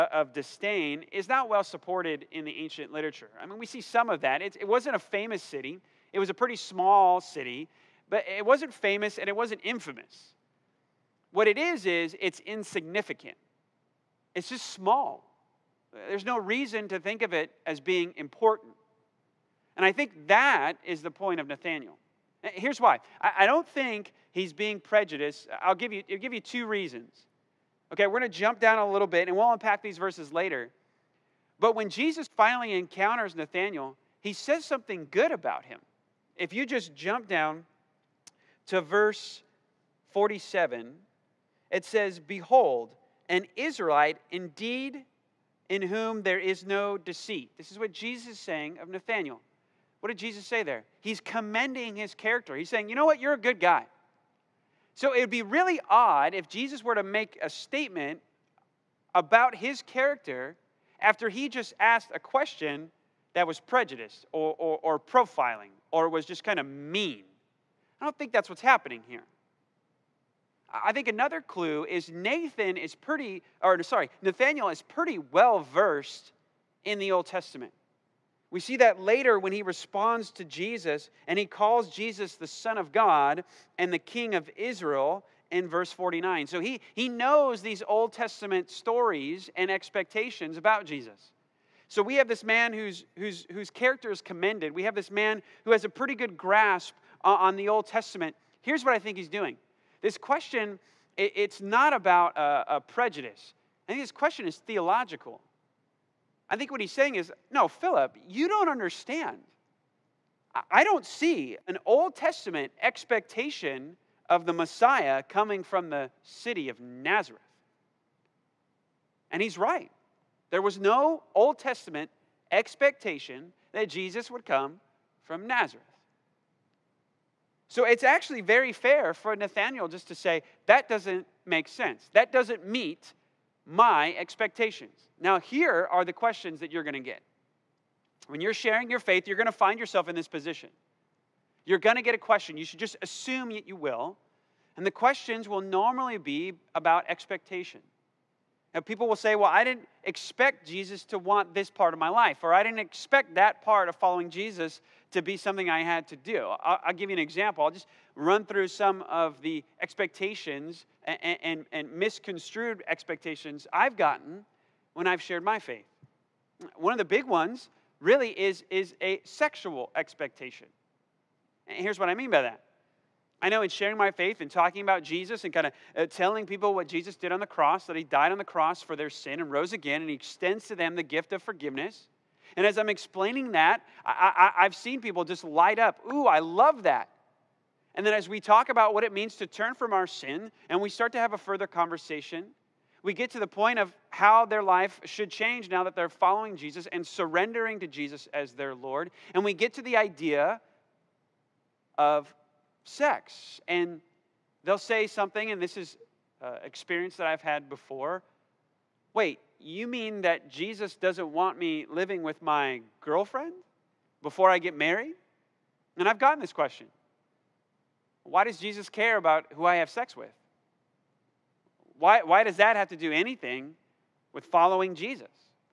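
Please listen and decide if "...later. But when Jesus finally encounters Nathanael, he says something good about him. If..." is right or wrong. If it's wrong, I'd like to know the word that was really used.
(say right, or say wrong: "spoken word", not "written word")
right.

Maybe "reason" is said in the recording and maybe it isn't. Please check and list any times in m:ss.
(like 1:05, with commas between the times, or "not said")
0:16, 0:26.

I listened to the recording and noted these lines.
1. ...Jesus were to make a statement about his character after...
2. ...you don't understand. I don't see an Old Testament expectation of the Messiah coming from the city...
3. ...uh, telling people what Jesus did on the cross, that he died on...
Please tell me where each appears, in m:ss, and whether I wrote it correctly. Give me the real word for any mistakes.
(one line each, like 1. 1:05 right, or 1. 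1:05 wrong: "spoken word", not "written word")
1. 0:56 right
2. 1:48 right
3. 2:55 right.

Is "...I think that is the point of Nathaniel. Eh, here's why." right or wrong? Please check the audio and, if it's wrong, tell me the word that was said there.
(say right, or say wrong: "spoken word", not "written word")
right.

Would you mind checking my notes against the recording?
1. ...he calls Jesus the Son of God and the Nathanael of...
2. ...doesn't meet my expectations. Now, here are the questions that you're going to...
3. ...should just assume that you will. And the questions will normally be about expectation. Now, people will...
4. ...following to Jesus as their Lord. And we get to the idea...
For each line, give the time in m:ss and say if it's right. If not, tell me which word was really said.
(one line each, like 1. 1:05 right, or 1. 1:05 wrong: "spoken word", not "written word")
1. 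1:21 wrong: "King", not "Nathanael"
2. 2:12 right
3. 2:22 right
4. 3:17 wrong: "surrendering", not "following".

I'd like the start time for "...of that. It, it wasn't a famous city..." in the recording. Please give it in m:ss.
0:04.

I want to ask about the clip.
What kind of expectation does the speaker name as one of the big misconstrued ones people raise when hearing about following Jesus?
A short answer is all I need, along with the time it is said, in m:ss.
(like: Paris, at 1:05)
sexual expectation, at 2:48.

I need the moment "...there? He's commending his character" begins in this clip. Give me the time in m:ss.
0:50.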